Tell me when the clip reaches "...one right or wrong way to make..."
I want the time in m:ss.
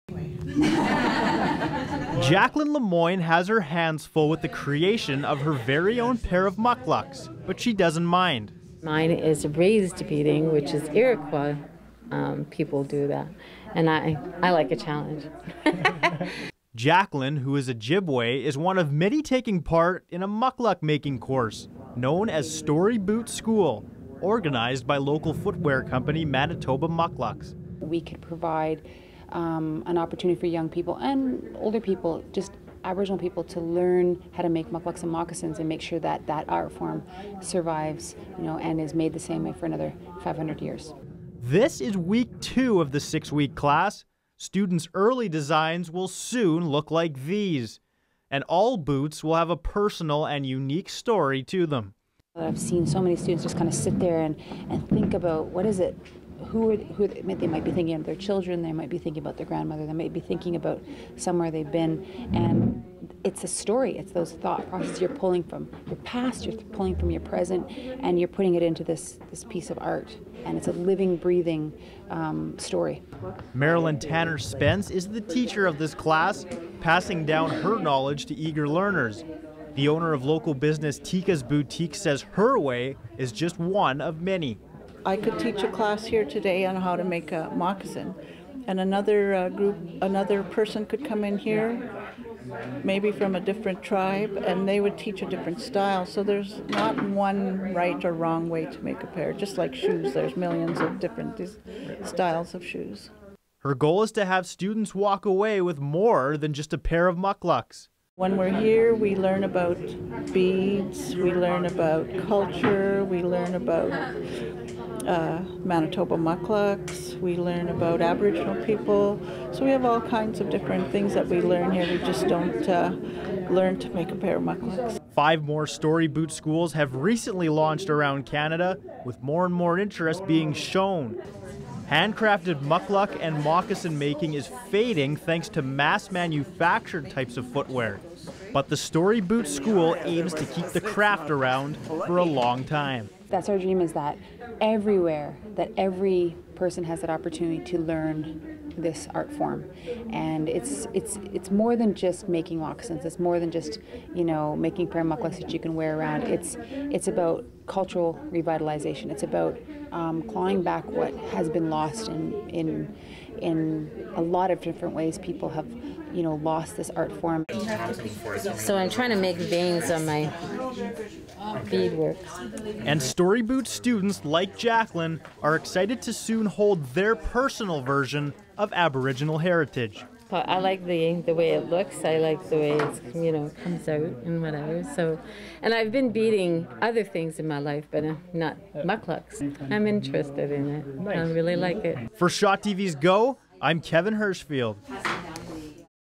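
1:37.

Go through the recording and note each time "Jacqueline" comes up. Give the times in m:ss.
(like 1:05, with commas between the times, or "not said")
0:02, 0:16, 2:54.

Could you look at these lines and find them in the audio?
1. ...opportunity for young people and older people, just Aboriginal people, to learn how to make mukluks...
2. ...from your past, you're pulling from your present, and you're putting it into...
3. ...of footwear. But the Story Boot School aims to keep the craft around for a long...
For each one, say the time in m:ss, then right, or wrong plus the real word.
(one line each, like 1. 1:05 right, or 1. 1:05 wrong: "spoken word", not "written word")
1. 0:29 right
2. 1:05 right
3. 2:17 right.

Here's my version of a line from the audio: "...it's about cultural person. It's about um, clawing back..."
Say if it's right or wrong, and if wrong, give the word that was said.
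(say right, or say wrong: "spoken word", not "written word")
wrong: "revitalization", not "person".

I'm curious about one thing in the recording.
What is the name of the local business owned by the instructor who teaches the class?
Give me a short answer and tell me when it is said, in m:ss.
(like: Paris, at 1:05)
Tika's Boutique, at 1:20.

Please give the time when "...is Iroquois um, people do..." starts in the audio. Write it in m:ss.
0:10.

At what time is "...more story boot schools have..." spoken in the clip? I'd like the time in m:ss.
2:05.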